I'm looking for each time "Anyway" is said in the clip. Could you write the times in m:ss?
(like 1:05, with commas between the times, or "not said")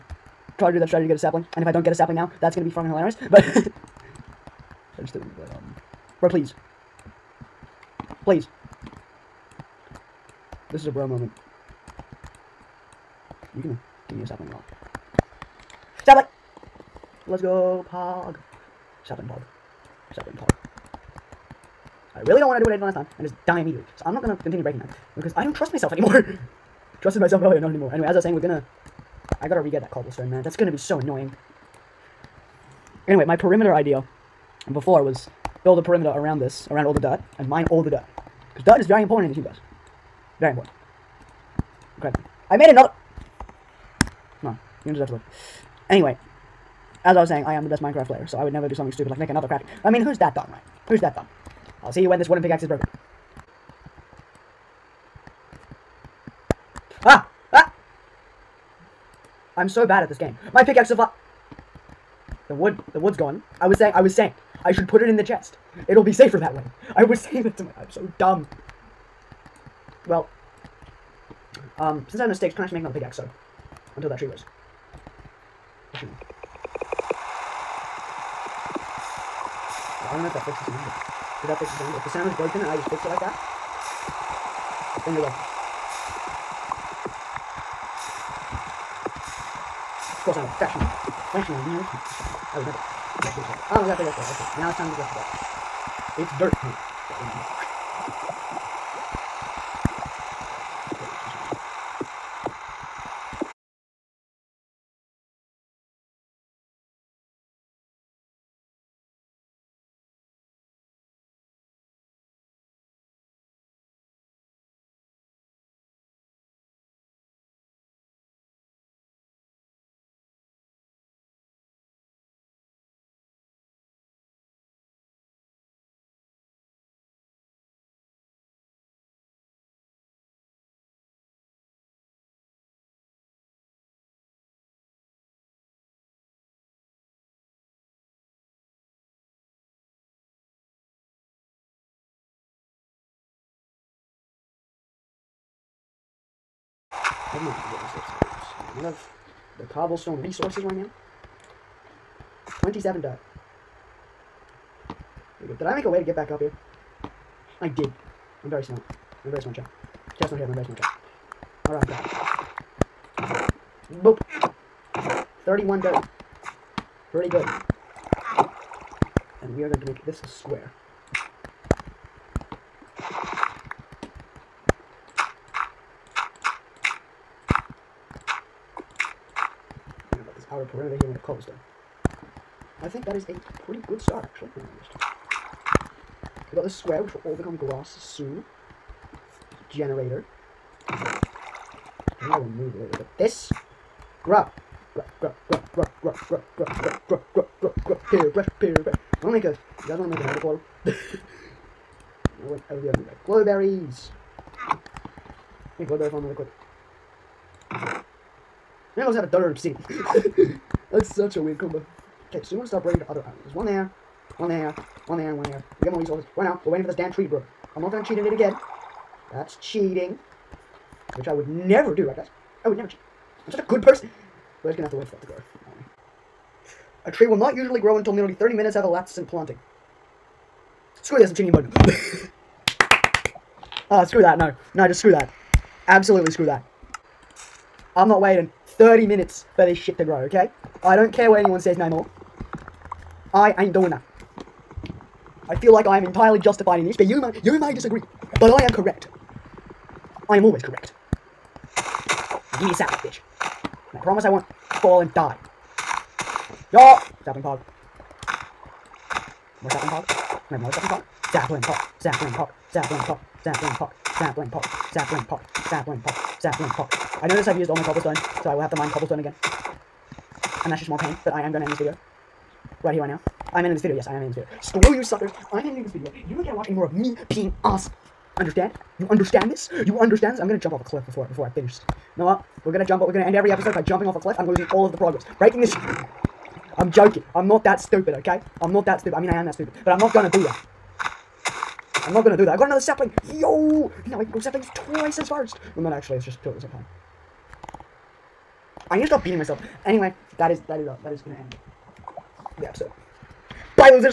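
0:27, 0:33, 0:45, 4:59.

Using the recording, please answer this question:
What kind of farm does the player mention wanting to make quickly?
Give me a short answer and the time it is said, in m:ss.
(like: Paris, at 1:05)
Woodbury farm, at 3:25.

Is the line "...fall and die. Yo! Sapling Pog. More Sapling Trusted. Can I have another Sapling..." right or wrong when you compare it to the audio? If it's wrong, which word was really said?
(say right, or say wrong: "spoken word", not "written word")
wrong: "Pog", not "Trusted".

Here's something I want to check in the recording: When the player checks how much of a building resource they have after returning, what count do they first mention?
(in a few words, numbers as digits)
27.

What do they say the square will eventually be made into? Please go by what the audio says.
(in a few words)
glass.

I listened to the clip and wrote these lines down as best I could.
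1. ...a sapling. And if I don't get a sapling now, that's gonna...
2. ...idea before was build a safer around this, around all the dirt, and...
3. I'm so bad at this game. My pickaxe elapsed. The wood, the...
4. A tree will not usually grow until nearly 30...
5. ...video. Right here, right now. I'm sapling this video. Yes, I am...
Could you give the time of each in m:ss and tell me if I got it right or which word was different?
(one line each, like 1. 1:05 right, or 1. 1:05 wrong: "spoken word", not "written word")
1. 0:01 right
2. 0:33 wrong: "perimeter", not "safer"
3. 0:59 wrong: "survived", not "elapsed"
4. 3:47 right
5. 4:31 wrong: "ending", not "sapling".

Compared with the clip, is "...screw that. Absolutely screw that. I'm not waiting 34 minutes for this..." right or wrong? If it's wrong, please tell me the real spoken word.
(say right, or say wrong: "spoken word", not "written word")
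wrong: "30", not "34".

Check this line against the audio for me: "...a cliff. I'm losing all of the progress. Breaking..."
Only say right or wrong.
right.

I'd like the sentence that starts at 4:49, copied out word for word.
I mean, I am that stupid, but I'm not gonna do that.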